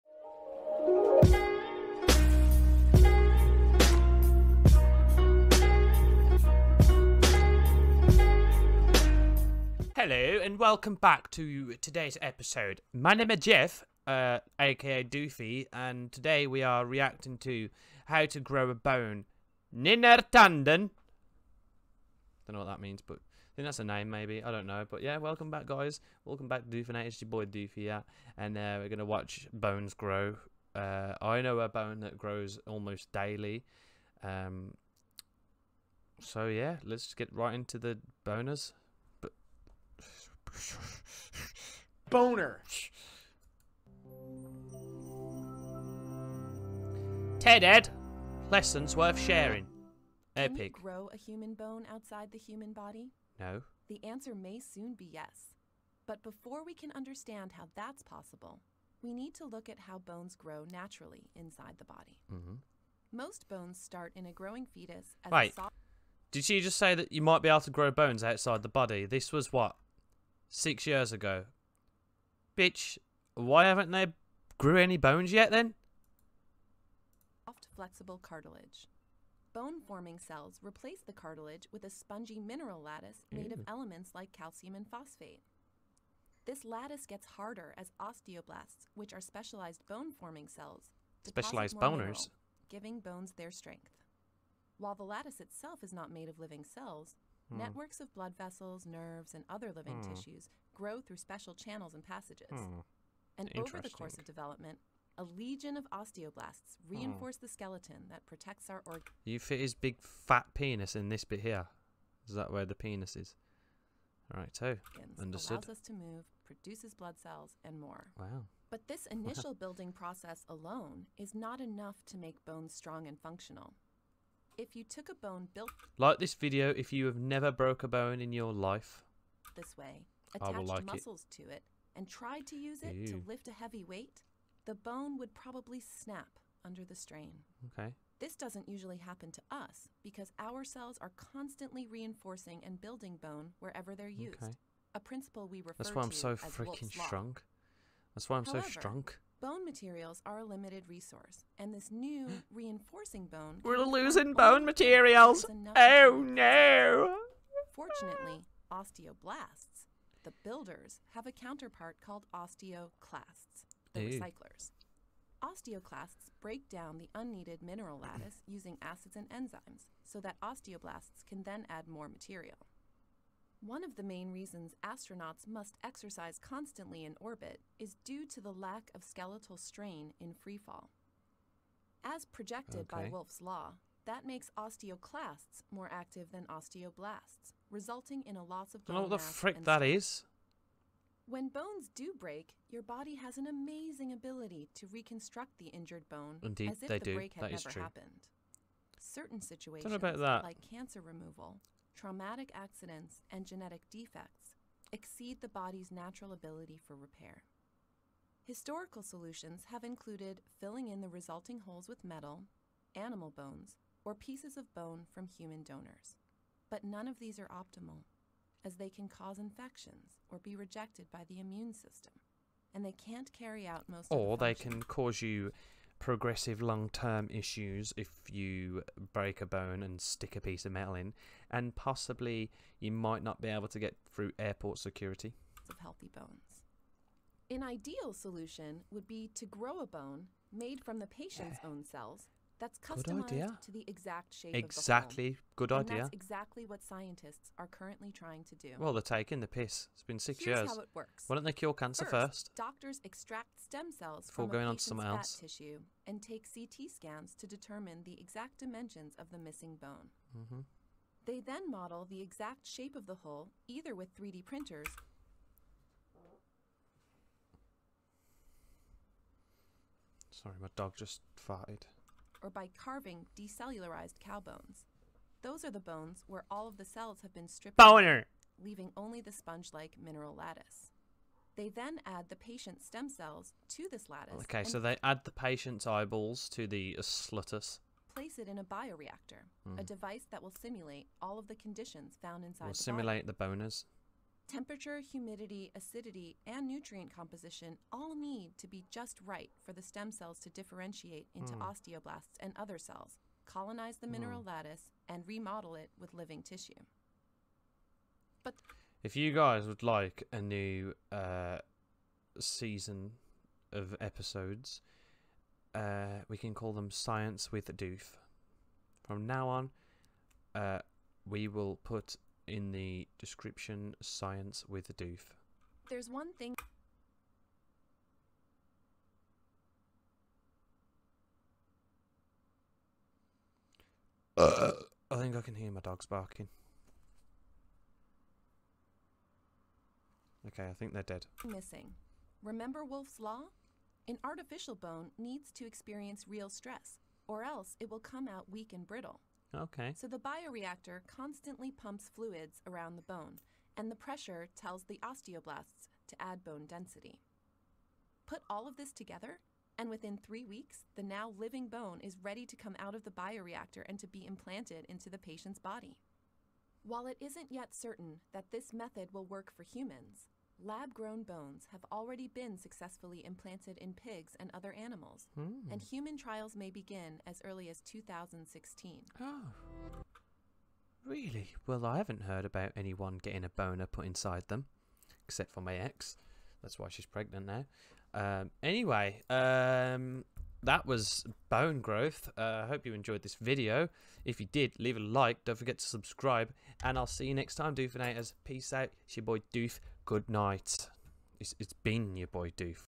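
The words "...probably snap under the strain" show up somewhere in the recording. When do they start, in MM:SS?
02:15.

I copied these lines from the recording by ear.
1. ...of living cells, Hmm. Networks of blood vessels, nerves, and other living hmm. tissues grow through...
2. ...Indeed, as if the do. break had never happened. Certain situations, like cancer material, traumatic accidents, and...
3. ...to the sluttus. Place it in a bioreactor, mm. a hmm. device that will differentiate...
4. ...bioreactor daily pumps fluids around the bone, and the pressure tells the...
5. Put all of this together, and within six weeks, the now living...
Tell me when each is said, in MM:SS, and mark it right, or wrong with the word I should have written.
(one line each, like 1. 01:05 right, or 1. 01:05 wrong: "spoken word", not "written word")
1. 01:36 right
2. 03:16 wrong: "removal", not "material"
3. 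04:46 wrong: "simulate", not "differentiate"
4. 05:50 wrong: "constantly", not "daily"
5. 05:58 wrong: "three", not "six".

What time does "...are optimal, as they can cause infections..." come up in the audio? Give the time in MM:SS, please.
03:37.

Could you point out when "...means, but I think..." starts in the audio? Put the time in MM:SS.
00:22.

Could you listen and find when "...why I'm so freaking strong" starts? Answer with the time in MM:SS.
02:25.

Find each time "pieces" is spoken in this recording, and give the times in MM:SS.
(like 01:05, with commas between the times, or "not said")
03:34, 03:50.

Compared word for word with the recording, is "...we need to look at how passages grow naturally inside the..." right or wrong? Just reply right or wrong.
wrong.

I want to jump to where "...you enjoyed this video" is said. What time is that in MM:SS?
06:32.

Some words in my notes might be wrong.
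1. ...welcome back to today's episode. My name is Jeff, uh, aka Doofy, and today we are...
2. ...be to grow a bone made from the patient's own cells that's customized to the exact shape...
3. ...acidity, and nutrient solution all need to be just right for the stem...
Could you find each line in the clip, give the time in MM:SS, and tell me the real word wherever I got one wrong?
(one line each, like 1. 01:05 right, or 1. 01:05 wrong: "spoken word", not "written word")
1. 00:10 right
2. 03:59 right
3. 04:55 wrong: "composition", not "solution".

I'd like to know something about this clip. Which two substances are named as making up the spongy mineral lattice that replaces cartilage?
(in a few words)
calcium and phosphate.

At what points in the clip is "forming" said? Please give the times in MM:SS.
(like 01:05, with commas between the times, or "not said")
01:19, 01:29.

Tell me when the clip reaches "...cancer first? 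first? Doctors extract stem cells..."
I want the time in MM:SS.
04:11.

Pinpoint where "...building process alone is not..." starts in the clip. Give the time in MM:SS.
01:59.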